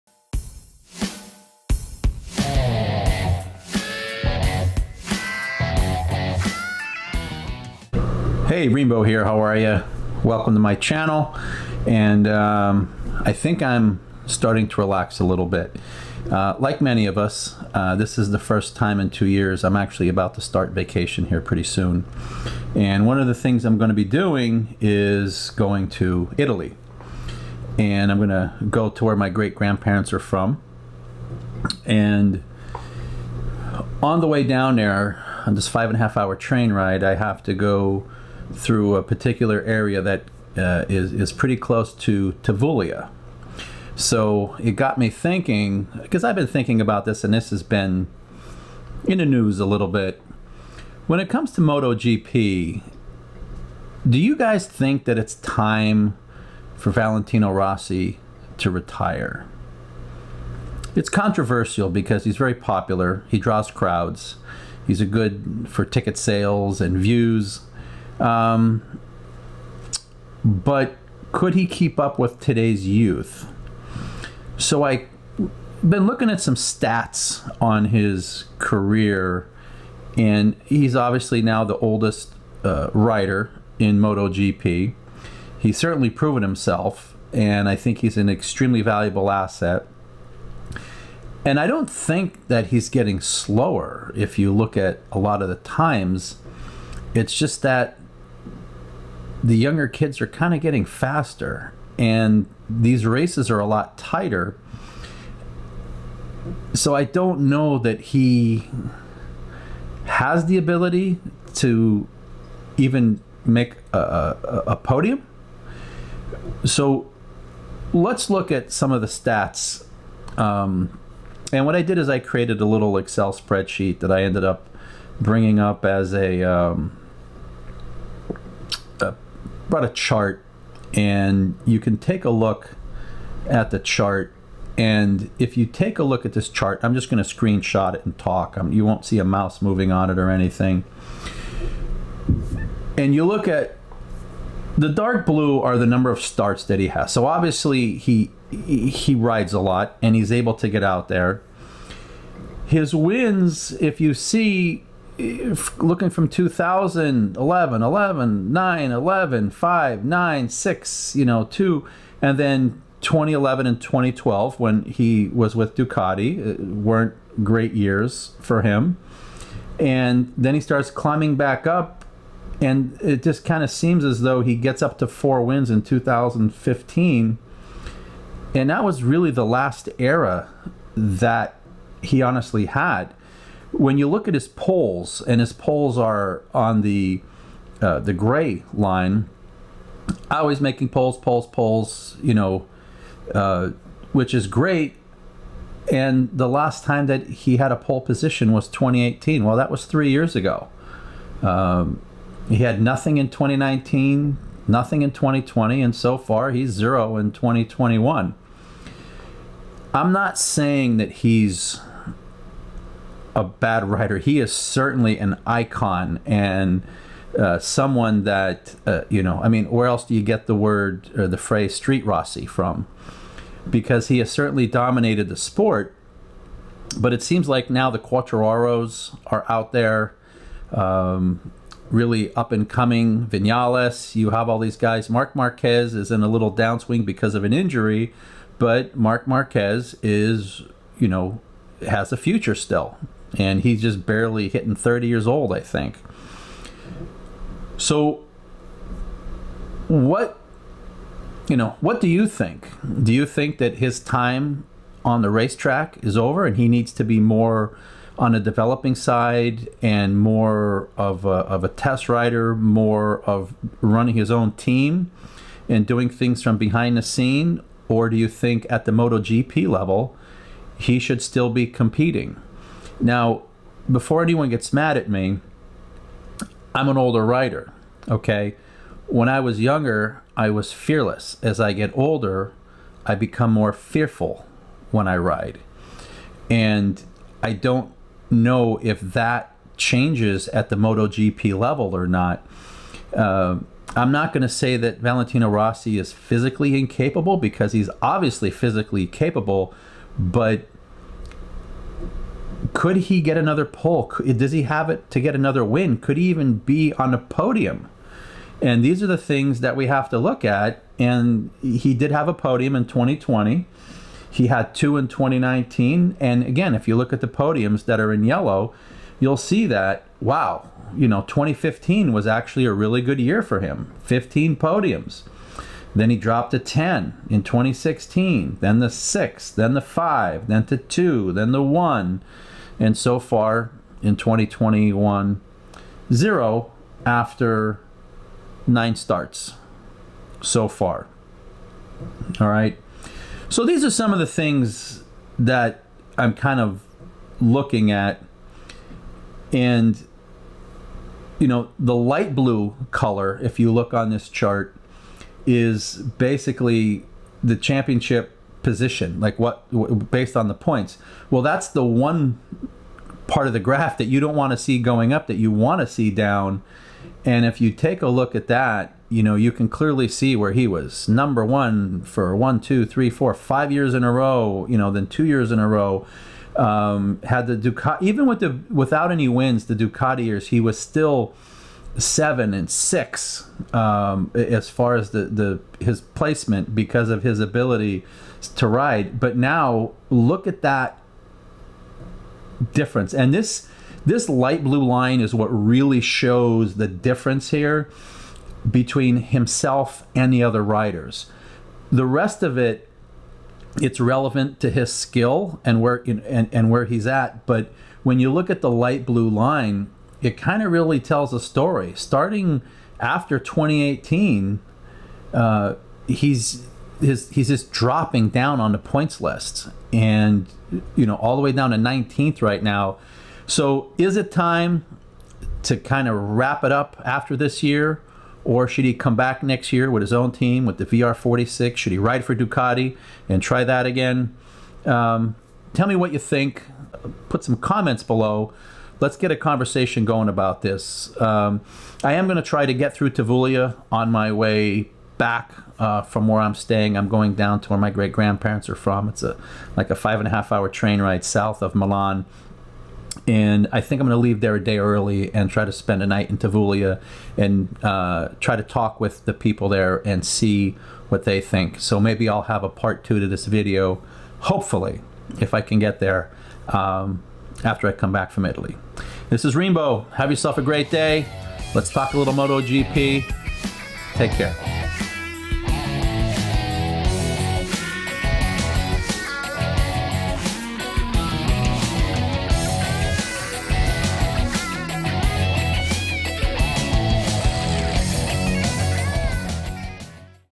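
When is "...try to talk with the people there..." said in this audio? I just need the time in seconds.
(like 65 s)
458 s.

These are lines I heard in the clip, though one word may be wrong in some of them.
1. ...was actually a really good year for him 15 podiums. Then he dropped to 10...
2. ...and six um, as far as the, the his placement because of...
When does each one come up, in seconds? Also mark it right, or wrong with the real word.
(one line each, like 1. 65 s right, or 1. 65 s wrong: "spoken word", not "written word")
1. 322 s right
2. 382 s right.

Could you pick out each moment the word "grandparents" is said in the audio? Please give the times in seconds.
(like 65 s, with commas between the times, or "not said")
29 s, 448 s.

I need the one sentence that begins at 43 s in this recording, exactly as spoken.
So it got me thinking because I've been thinking about this, and this has been in the news a little bit.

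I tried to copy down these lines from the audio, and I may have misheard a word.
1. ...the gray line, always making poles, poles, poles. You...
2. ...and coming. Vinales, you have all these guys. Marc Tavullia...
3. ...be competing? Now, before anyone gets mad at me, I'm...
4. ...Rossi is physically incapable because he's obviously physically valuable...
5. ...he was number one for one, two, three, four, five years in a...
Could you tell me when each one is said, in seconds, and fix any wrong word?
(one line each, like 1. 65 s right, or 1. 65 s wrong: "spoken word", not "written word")
1. 187 s right
2. 232 s wrong: "Marquez", not "Tavullia"
3. 271 s right
4. 295 s wrong: "capable", not "valuable"
5. 370 s right.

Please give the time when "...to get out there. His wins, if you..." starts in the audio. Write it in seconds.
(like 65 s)
150 s.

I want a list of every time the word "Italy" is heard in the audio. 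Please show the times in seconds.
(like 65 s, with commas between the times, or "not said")
26 s, 468 s.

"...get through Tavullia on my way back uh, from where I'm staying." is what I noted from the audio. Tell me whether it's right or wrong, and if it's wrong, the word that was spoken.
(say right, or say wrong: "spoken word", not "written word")
right.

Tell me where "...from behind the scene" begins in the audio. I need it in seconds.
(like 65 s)
266 s.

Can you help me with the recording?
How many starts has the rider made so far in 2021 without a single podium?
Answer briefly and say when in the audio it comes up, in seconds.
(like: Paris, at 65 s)
9, at 338 s.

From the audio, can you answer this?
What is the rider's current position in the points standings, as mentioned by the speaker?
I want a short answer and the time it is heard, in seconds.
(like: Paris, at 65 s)
19th, at 421 s.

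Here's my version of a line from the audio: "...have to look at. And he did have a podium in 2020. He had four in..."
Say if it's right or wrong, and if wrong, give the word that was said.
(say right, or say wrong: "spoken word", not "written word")
wrong: "two", not "four".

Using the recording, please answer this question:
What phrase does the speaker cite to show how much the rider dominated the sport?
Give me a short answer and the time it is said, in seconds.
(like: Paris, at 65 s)
street Rossi, at 221 s.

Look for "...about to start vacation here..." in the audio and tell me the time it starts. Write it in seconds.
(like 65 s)
20 s.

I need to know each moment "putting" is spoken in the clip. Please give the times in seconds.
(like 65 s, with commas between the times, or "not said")
not said.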